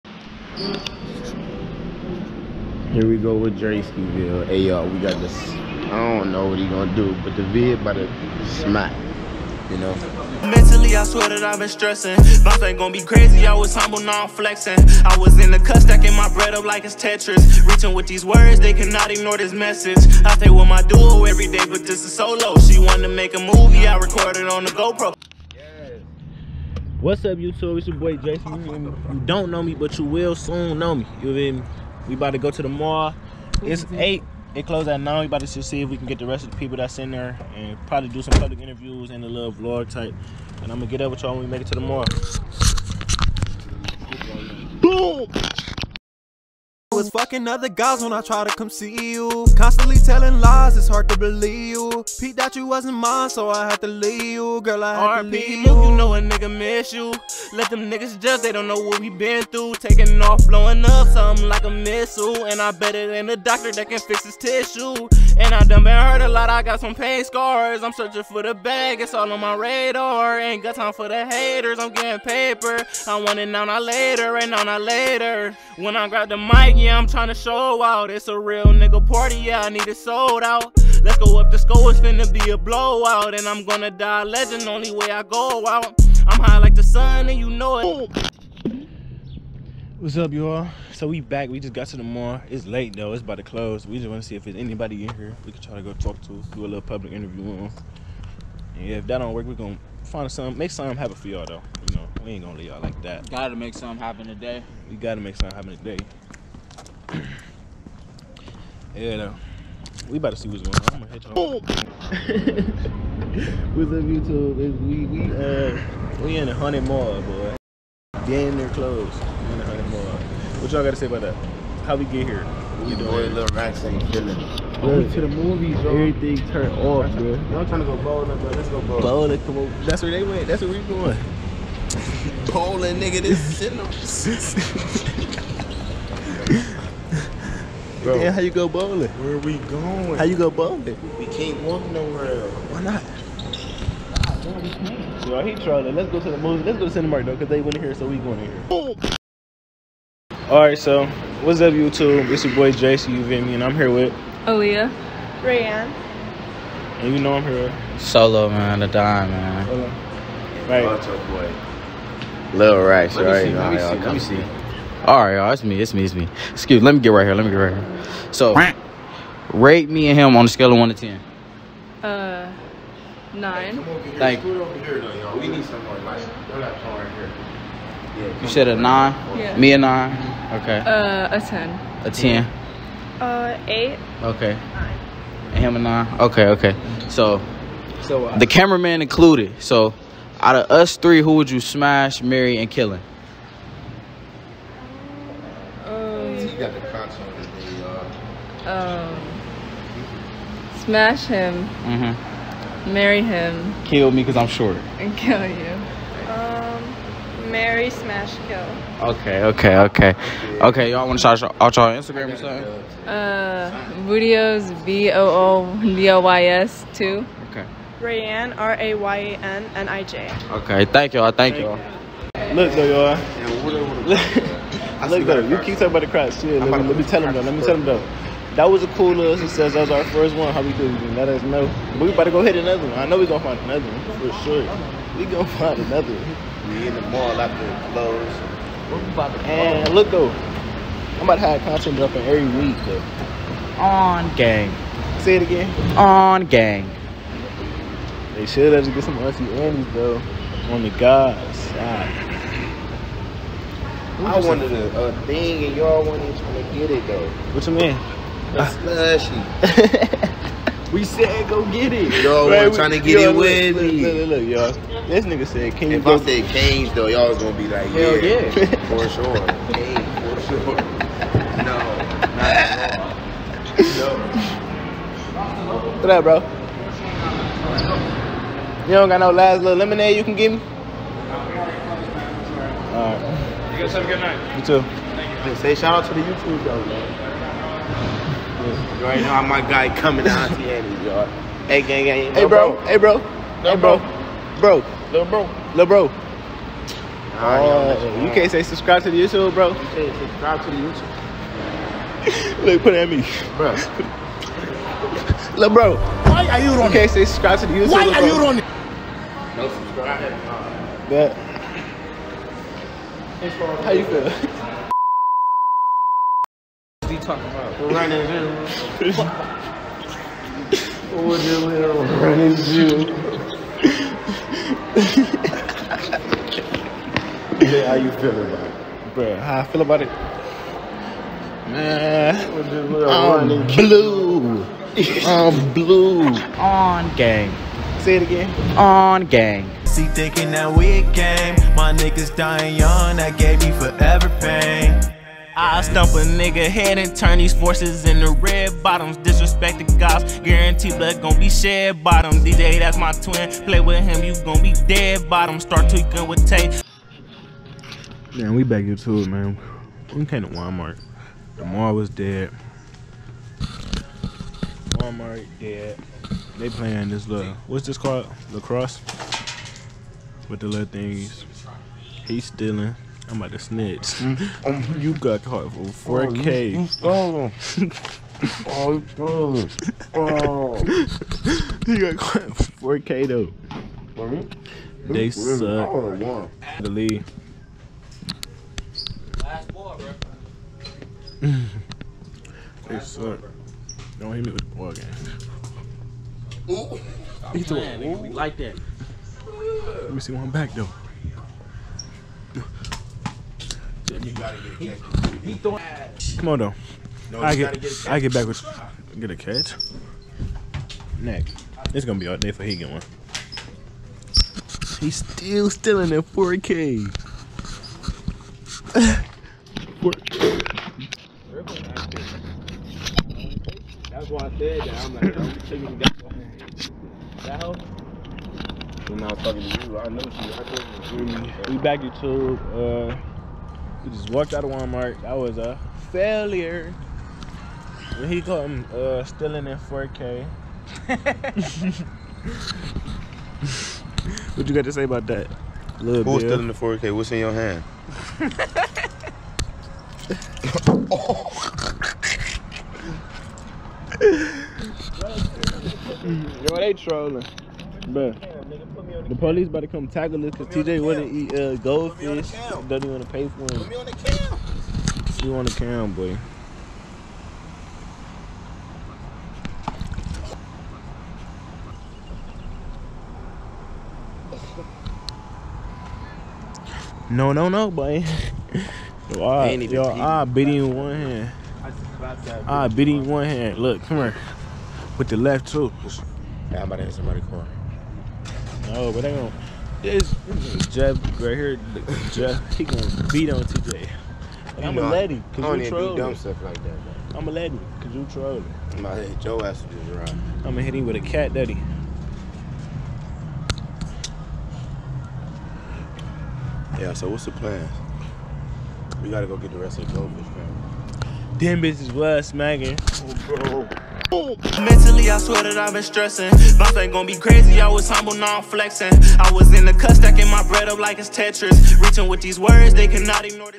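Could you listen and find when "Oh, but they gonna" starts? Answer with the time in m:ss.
8:08.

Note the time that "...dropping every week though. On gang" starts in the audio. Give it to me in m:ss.
4:01.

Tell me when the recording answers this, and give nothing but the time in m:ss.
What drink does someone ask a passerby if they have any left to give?
4:39.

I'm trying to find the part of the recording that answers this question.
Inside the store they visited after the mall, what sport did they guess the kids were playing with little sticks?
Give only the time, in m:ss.
6:08.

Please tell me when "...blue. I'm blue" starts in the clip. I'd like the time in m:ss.
5:33.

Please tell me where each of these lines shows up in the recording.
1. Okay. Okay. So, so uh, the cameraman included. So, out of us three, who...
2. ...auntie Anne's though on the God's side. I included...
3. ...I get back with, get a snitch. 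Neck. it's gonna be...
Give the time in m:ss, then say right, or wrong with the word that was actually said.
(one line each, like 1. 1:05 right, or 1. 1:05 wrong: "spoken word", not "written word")
1. 3:06 right
2. 4:09 wrong: "wanted", not "included"
3. 6:48 wrong: "catch", not "snitch".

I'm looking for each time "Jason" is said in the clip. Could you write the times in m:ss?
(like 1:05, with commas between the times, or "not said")
0:28, 2:32.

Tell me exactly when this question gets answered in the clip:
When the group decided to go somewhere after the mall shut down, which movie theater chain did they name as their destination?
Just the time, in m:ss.
2:27.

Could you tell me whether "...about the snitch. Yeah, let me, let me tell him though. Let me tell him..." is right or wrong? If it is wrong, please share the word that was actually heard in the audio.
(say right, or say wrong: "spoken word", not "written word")
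wrong: "crotch", not "snitch".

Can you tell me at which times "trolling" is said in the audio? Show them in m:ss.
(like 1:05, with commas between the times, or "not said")
2:25, 7:36, 8:18.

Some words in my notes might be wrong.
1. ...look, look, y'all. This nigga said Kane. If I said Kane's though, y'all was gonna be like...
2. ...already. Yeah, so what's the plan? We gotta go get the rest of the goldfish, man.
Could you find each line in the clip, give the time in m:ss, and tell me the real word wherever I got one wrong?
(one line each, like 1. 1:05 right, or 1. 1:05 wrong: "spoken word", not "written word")
1. 4:24 right
2. 8:21 wrong: "daddy", not "already".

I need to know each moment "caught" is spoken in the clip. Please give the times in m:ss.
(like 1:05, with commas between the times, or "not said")
6:15, 6:22.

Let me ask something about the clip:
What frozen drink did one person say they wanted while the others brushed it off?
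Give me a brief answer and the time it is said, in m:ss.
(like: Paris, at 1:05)
slushy, at 4:18.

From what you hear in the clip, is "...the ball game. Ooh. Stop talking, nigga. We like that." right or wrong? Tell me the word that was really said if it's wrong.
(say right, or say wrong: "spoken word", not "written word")
wrong: "playing", not "talking".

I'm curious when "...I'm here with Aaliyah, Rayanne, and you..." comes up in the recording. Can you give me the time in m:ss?
2:33.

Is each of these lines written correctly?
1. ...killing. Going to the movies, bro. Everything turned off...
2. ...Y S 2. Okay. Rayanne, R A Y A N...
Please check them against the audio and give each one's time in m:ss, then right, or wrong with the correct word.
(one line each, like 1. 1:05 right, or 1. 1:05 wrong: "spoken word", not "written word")
1. 2:04 right
2. 3:36 right.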